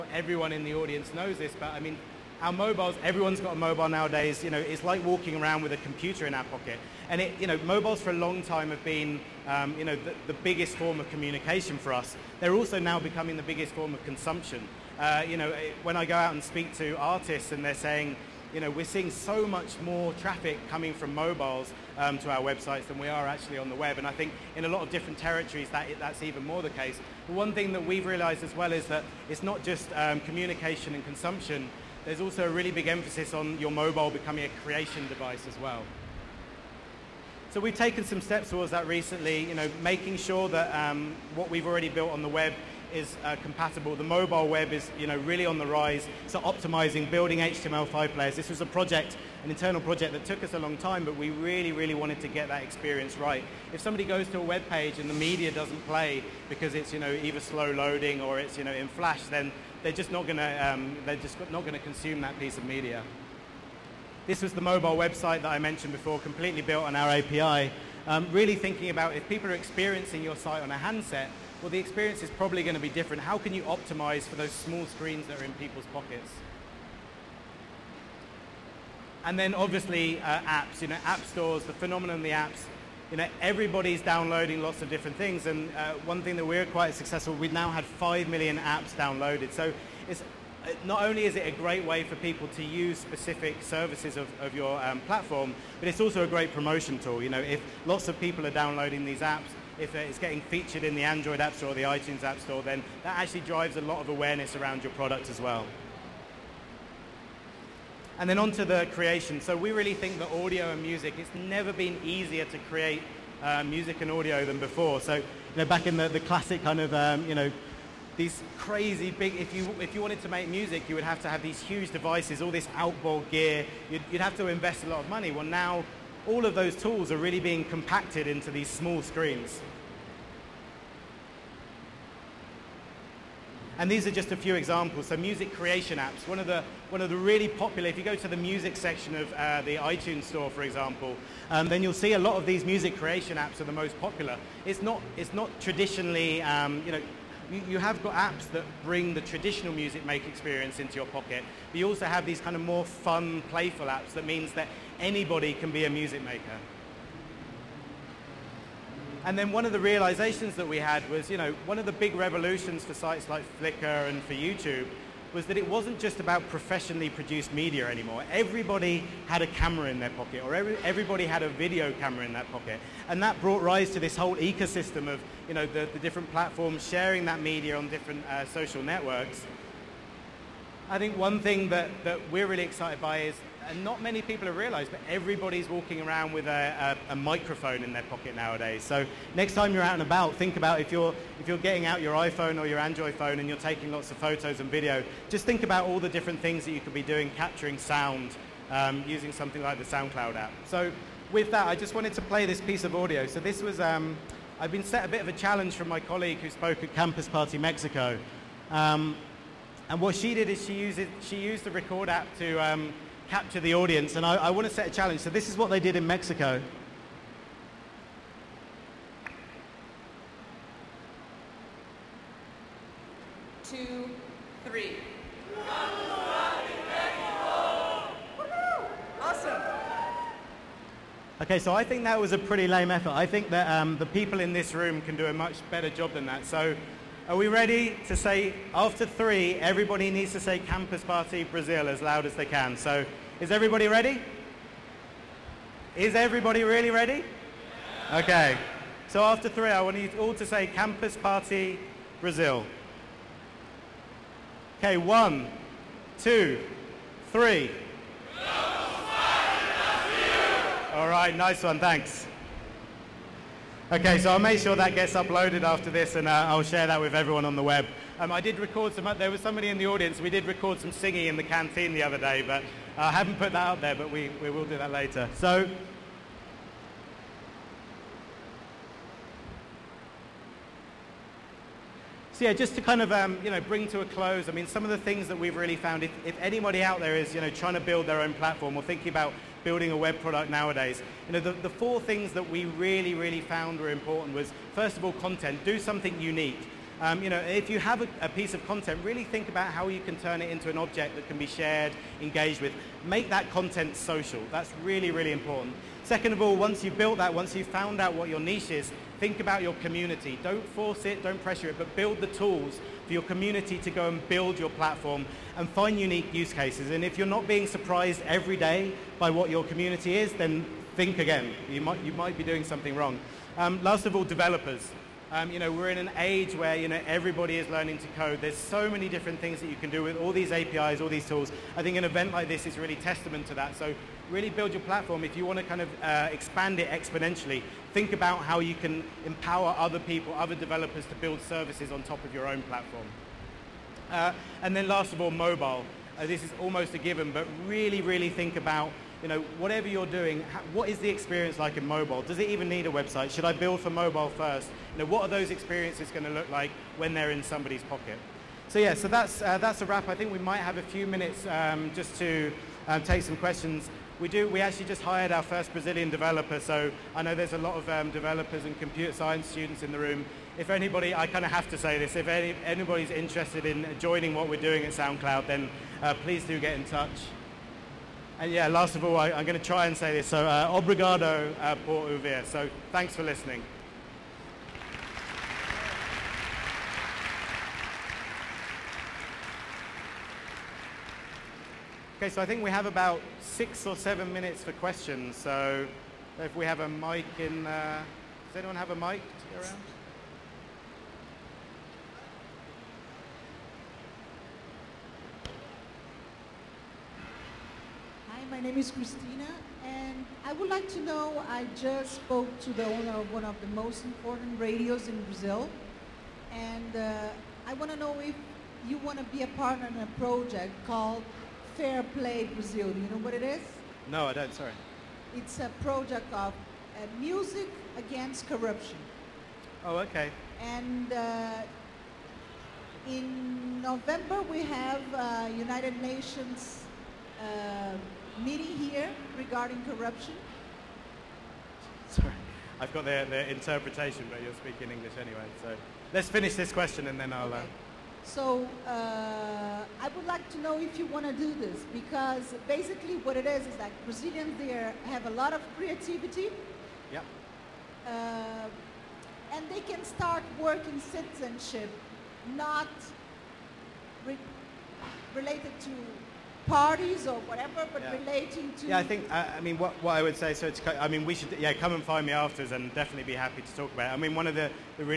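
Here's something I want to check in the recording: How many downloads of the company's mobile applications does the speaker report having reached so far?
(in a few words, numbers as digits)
5 million.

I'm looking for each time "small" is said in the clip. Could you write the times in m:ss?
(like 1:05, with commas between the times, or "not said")
1:14, 2:08.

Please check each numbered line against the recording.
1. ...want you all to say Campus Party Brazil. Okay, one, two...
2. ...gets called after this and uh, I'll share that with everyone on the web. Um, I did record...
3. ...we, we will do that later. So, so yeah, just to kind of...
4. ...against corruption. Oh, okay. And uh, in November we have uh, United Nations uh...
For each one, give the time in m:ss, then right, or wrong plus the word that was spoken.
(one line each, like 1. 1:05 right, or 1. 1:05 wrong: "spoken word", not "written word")
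1. 4:09 right
2. 4:24 wrong: "uploaded", not "called"
3. 4:34 right
4. 7:07 right.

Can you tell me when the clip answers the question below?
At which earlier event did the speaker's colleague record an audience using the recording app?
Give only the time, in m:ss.
3:26.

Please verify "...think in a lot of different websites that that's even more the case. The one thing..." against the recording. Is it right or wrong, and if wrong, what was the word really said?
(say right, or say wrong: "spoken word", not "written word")
wrong: "territories", not "websites".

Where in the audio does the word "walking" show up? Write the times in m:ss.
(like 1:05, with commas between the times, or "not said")
0:05, 3:05.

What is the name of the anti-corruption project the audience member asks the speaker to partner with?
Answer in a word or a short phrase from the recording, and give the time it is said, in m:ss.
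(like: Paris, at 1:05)
Fair Play Brazil, at 7:01.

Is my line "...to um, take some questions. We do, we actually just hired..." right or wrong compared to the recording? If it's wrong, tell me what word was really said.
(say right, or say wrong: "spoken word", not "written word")
right.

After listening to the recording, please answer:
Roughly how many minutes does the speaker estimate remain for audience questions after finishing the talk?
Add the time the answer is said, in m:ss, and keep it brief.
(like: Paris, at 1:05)
six or seven, at 6:33.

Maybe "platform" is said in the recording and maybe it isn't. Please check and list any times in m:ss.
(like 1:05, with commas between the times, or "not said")
1:34, 2:56, 4:48, 5:14, 5:34, 5:42.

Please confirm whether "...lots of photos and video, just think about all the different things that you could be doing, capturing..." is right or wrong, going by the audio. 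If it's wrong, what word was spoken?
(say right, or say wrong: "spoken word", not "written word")
right.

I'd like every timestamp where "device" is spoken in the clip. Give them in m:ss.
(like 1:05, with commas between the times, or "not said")
0:35, 2:01.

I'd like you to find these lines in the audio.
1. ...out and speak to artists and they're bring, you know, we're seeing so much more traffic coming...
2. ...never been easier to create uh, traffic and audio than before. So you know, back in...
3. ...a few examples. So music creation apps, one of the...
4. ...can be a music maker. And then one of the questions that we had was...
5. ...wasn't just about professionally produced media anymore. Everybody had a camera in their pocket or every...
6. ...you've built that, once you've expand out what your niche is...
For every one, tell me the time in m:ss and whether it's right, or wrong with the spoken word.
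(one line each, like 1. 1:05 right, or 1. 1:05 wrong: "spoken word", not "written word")
1. 0:16 wrong: "saying", not "bring"
2. 1:51 wrong: "music", not "traffic"
3. 2:14 right
4. 2:35 wrong: "realizations", not "questions"
5. 2:45 right
6. 5:06 wrong: "found", not "expand".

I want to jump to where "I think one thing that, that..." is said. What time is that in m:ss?
3:00.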